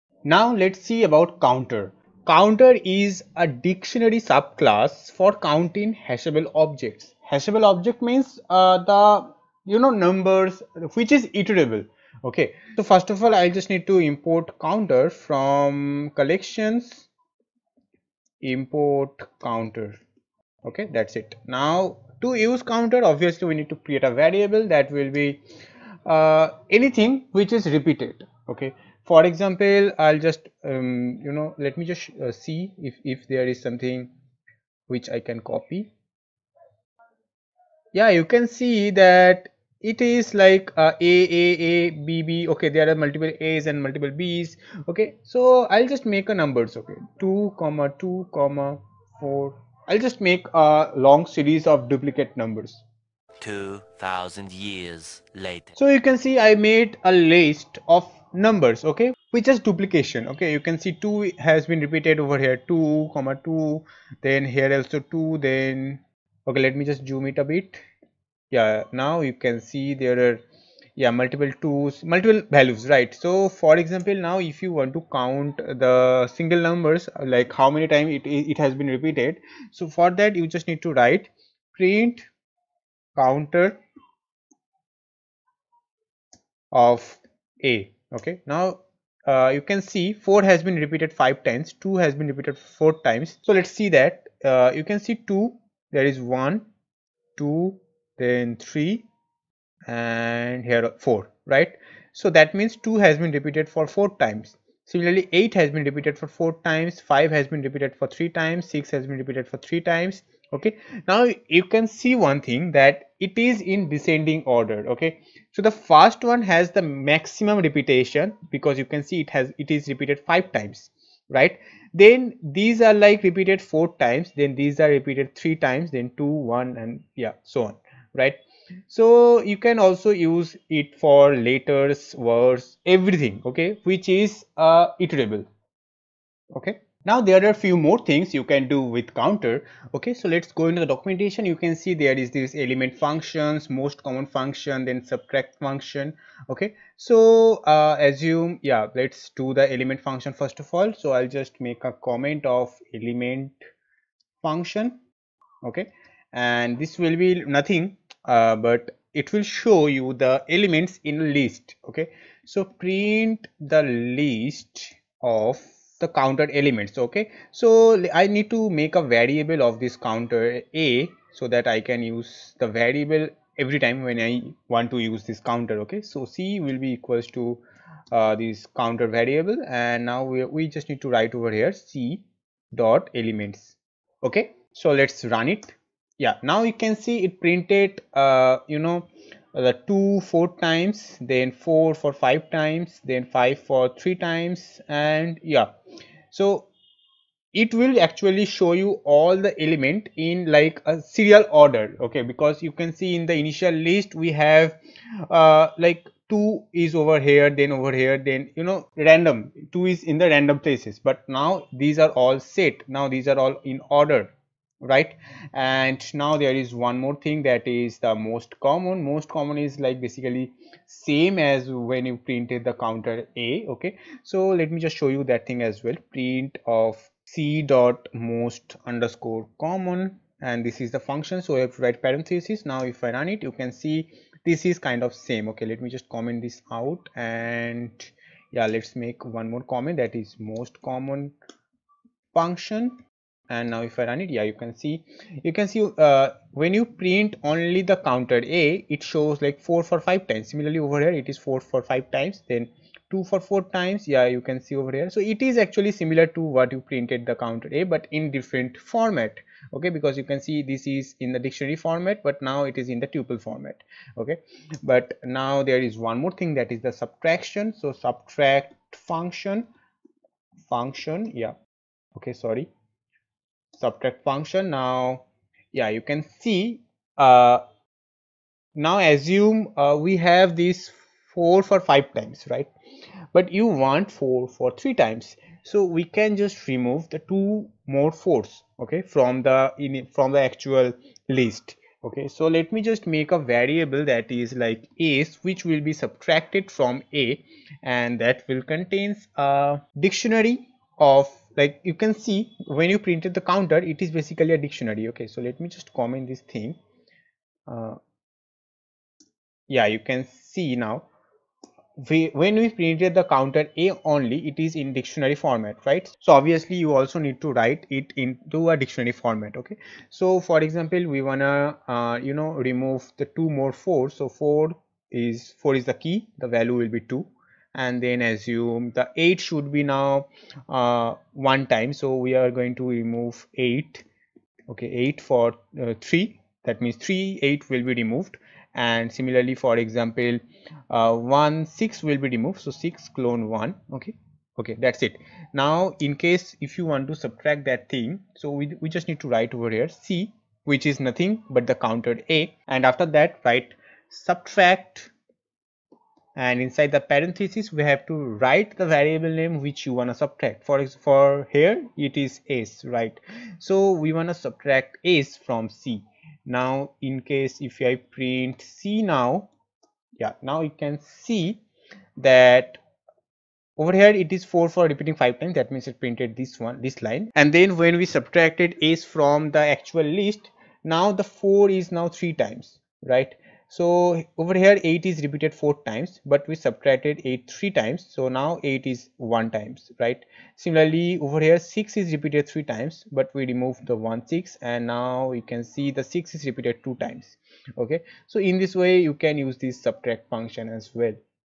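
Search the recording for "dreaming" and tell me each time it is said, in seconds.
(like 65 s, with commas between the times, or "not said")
not said.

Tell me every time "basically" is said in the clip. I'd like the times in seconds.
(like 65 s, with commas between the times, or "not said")
220 s, 304 s.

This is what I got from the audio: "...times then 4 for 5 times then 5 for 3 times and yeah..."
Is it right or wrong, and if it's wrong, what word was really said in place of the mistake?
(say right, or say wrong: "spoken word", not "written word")
right.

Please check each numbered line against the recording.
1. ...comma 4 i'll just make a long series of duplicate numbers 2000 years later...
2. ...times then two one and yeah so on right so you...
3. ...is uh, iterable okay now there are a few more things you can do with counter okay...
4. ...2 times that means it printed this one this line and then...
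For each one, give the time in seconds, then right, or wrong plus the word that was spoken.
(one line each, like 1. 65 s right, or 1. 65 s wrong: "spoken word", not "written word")
1. 48 s right
2. 125 s right
3. 134 s right
4. 375 s wrong: "5", not "2".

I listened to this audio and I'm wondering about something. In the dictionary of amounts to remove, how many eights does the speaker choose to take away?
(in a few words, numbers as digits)
3.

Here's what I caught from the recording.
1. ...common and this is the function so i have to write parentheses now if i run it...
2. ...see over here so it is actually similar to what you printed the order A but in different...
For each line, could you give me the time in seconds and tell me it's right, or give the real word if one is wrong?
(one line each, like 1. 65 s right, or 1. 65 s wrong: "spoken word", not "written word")
1. 229 s right
2. 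254 s wrong: "counter", not "order".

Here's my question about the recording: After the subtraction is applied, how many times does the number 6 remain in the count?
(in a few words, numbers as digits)
2.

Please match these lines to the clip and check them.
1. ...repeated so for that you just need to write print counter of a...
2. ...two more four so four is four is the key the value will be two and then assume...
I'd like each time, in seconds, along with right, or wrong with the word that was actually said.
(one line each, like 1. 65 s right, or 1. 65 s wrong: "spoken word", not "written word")
1. 78 s right
2. 323 s right.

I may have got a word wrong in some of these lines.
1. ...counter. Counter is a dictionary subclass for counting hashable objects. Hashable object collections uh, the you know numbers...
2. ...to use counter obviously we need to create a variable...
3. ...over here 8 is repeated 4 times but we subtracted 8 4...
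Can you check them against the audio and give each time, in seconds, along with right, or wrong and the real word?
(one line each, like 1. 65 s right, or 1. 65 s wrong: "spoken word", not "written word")
1. 1 s wrong: "means", not "collections"
2. 22 s right
3. 384 s wrong: "3", not "4".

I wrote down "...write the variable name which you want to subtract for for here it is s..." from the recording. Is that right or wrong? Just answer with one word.
right.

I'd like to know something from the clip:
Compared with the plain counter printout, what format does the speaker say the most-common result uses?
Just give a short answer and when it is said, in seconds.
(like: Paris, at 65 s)
tuple format, at 263 s.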